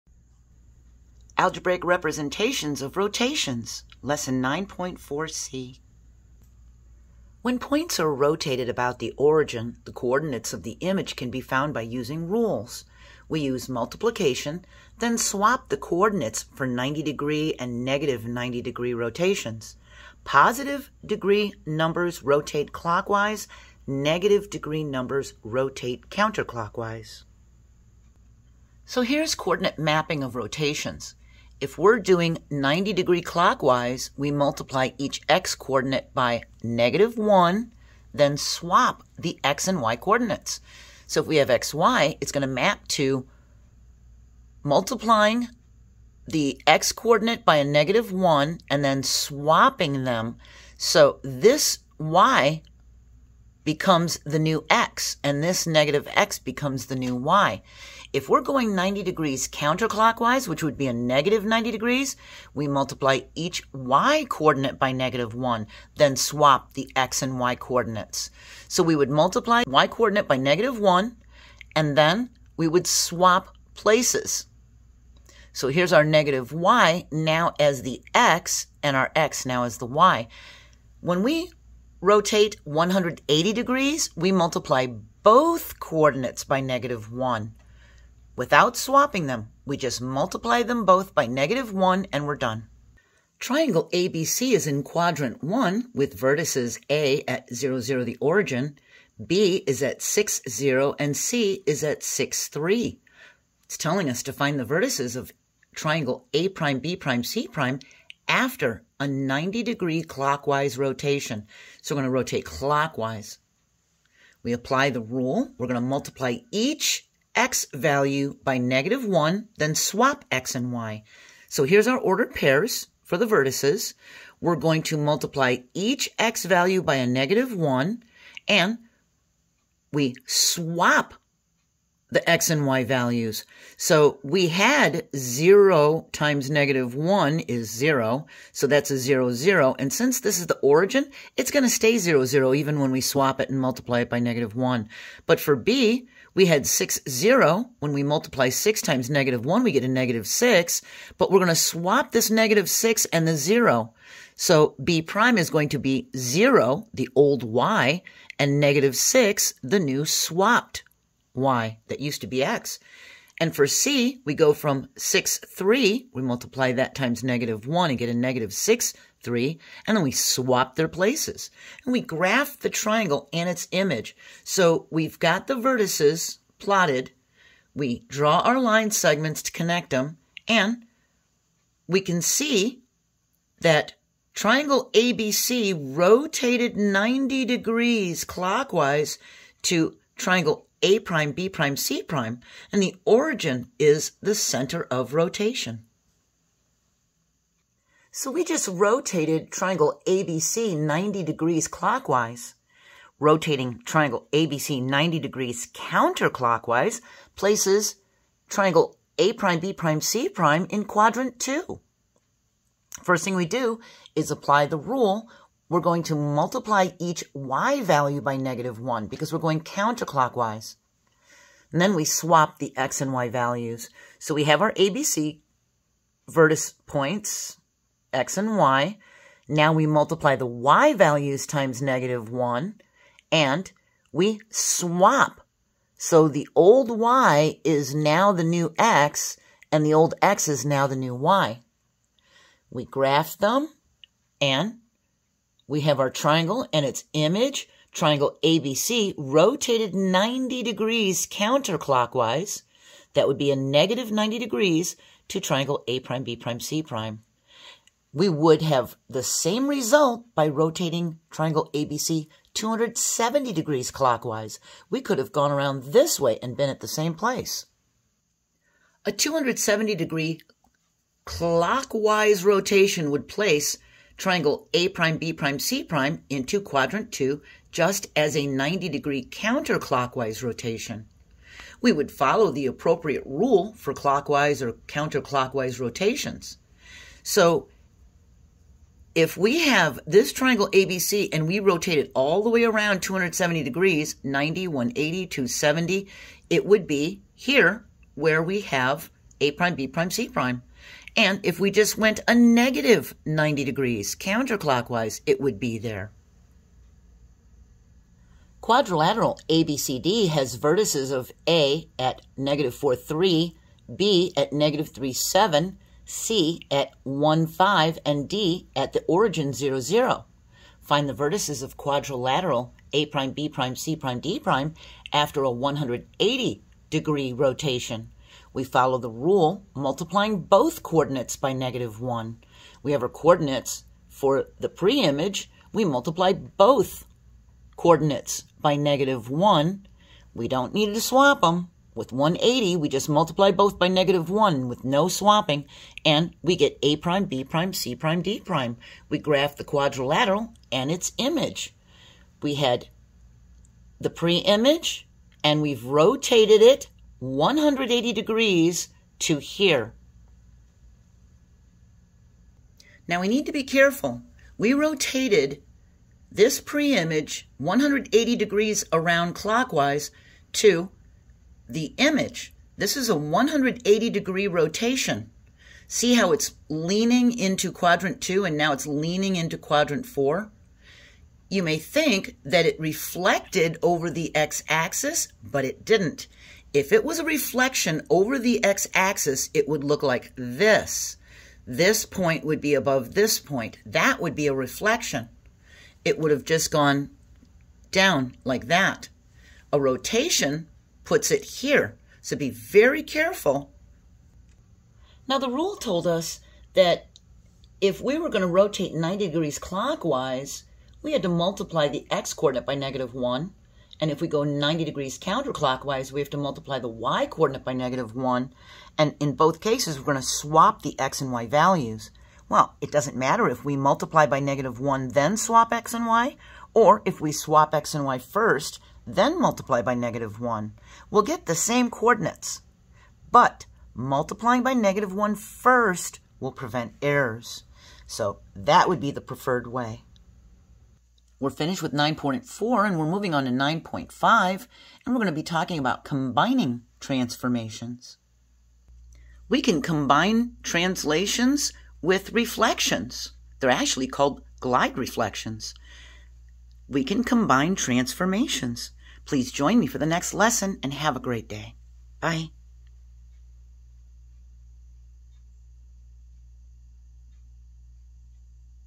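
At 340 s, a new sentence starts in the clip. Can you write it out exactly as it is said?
We don't need to swap them.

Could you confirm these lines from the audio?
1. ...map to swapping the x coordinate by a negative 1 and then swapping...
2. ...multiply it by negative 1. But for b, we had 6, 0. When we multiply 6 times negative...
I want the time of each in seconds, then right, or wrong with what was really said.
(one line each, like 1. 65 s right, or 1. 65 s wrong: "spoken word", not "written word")
1. 42 s wrong: "multiplying", not "swapping"
2. 143 s right.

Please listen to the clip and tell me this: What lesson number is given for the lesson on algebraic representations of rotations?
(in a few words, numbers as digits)
9.4c.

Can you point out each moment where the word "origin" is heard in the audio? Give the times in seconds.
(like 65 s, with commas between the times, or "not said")
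9 s, 98 s, 140 s, 193 s, 319 s.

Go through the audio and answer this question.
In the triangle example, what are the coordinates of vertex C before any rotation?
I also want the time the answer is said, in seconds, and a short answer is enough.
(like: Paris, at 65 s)
(6, 3), at 101 s.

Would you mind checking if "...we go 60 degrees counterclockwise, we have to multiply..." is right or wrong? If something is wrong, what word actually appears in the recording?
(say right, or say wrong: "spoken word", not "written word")
wrong: "90", not "60".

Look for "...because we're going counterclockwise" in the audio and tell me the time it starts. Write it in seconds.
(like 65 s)
219 s.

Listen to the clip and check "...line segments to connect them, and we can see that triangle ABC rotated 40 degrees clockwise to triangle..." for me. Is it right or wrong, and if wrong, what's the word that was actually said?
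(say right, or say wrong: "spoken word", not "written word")
wrong: "90", not "40".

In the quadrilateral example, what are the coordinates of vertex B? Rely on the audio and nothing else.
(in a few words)
(-3, 7).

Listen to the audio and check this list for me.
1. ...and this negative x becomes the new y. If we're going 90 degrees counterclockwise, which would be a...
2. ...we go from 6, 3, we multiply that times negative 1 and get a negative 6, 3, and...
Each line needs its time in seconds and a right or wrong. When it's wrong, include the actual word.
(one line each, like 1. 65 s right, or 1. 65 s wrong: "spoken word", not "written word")
1. 55 s right
2. 164 s right.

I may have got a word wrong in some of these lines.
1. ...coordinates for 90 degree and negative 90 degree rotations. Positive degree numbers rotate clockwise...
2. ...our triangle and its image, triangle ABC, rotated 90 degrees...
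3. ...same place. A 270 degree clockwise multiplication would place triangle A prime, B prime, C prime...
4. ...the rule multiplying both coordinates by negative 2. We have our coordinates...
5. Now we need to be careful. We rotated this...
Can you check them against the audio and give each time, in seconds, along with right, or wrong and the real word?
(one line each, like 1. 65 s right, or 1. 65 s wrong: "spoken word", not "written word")
1. 15 s right
2. 246 s right
3. 266 s wrong: "rotation", not "multiplication"
4. 328 s wrong: "1", not "2"
5. 363 s right.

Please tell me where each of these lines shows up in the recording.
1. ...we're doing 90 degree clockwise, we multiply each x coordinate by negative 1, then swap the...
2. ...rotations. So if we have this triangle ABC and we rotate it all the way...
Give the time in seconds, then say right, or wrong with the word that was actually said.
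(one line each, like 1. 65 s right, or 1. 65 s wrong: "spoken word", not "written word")
1. 31 s right
2. 285 s right.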